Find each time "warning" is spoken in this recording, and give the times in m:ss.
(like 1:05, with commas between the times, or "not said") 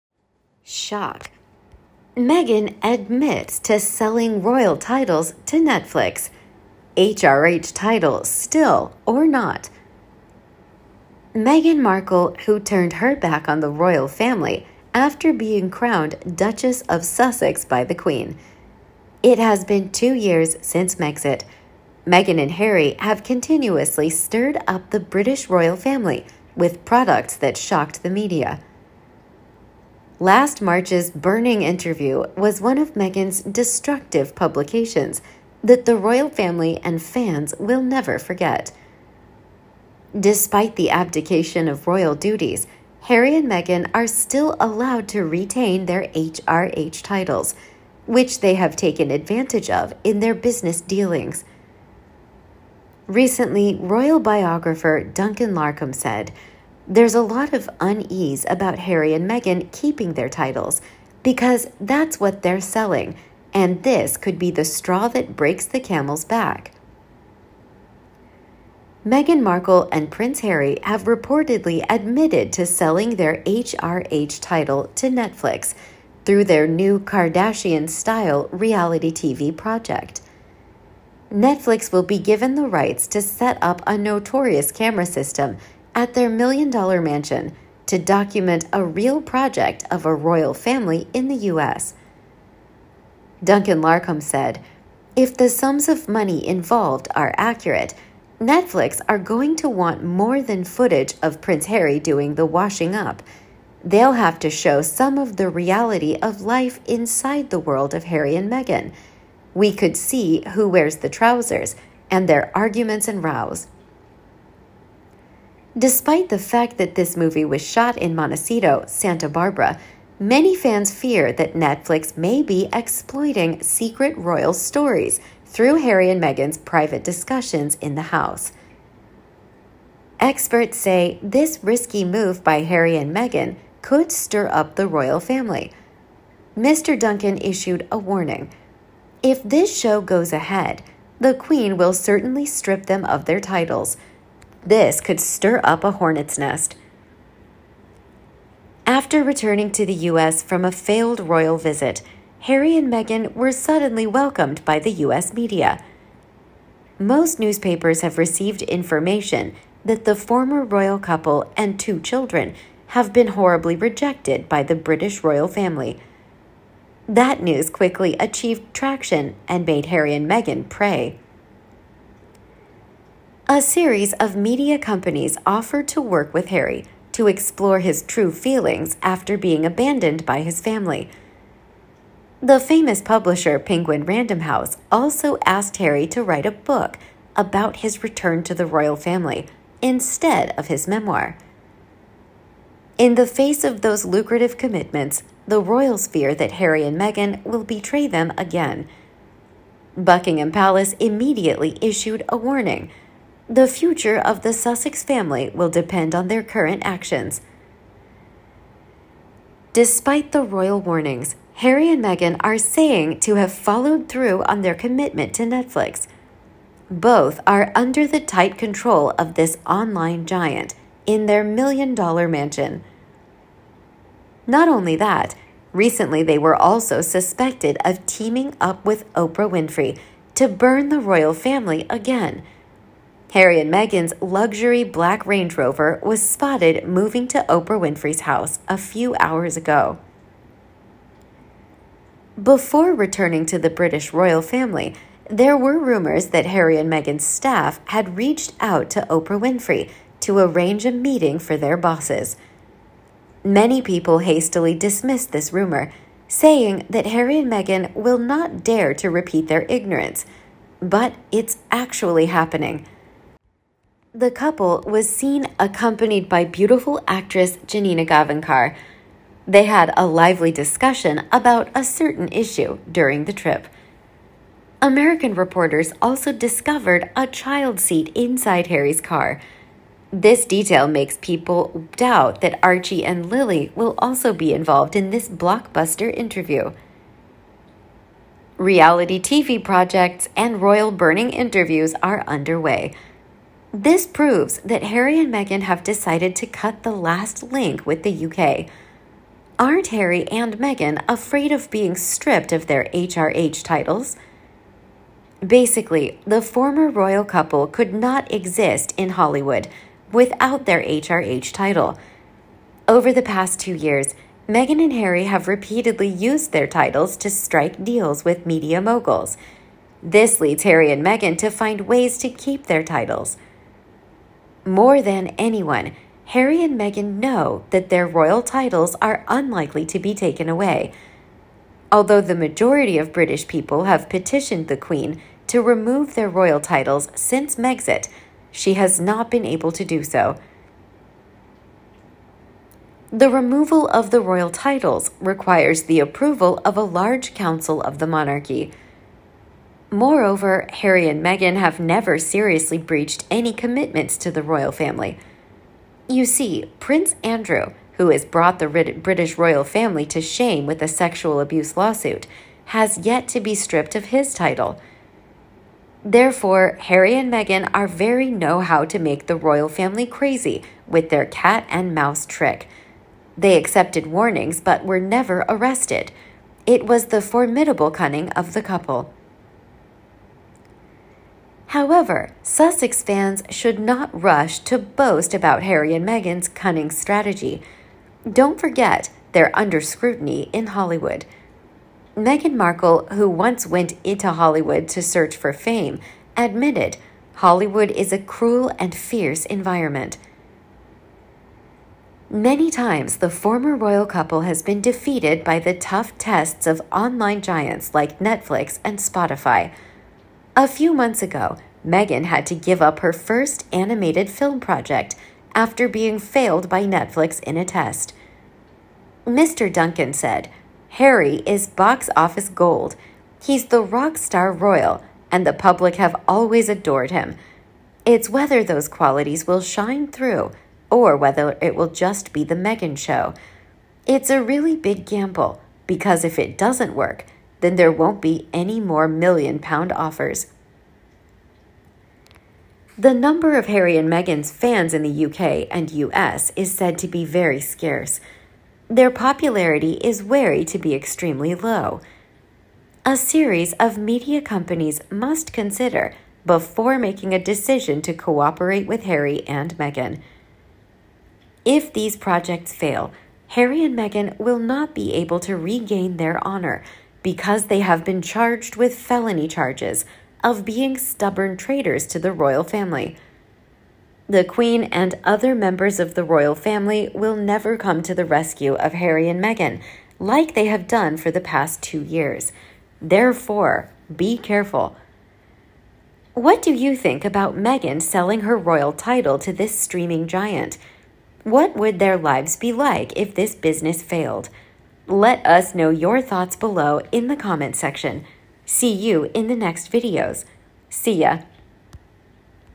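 2:17, 3:22, 3:30, 6:14.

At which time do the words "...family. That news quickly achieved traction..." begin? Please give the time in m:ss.
2:45.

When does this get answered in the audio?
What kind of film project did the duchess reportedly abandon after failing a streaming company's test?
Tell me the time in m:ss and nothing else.
6:53.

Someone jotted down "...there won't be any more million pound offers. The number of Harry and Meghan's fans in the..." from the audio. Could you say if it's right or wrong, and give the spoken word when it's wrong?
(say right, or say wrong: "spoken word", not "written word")
right.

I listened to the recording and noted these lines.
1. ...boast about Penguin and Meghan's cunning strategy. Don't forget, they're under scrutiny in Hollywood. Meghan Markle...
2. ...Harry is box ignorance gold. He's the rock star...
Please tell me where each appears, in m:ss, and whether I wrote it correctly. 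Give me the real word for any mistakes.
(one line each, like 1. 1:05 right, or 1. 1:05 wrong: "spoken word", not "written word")
1. 6:24 wrong: "Harry", not "Penguin"
2. 7:00 wrong: "office", not "ignorance".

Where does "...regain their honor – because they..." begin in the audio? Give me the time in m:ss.
7:45.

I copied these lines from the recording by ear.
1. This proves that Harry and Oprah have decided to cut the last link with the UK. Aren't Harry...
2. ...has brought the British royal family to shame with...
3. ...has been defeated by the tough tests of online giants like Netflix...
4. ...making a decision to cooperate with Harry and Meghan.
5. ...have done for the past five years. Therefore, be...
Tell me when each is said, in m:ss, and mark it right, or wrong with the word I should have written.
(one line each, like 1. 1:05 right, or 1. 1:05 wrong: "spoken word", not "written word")
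1. 4:53 wrong: "Meghan", not "Oprah"
2. 5:58 right
3. 6:44 right
4. 7:36 right
5. 8:00 wrong: "two", not "five".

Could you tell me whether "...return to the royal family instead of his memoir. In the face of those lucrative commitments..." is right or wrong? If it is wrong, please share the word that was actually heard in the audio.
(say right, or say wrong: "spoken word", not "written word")
right.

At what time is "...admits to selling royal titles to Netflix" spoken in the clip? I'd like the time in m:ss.
0:02.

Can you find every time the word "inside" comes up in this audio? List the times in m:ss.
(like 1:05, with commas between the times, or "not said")
1:46, 4:38.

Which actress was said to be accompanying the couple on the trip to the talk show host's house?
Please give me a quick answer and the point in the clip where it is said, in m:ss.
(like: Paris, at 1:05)
Janina Gavankar, at 4:27.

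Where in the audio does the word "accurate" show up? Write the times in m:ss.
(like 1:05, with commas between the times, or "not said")
1:37.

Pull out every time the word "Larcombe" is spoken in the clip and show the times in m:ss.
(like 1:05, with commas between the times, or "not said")
0:55, 1:33.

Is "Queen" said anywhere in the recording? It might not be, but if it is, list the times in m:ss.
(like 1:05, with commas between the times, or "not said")
0:17, 2:21, 5:34, 7:54.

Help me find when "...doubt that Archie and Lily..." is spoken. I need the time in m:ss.
4:41.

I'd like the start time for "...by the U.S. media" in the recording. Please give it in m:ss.
2:34.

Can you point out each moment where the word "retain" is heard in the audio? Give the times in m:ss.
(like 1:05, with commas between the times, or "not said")
0:45.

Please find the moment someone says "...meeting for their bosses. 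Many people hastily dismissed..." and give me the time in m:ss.
4:10.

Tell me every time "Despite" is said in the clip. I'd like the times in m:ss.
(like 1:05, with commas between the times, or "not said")
0:40, 1:55, 3:29.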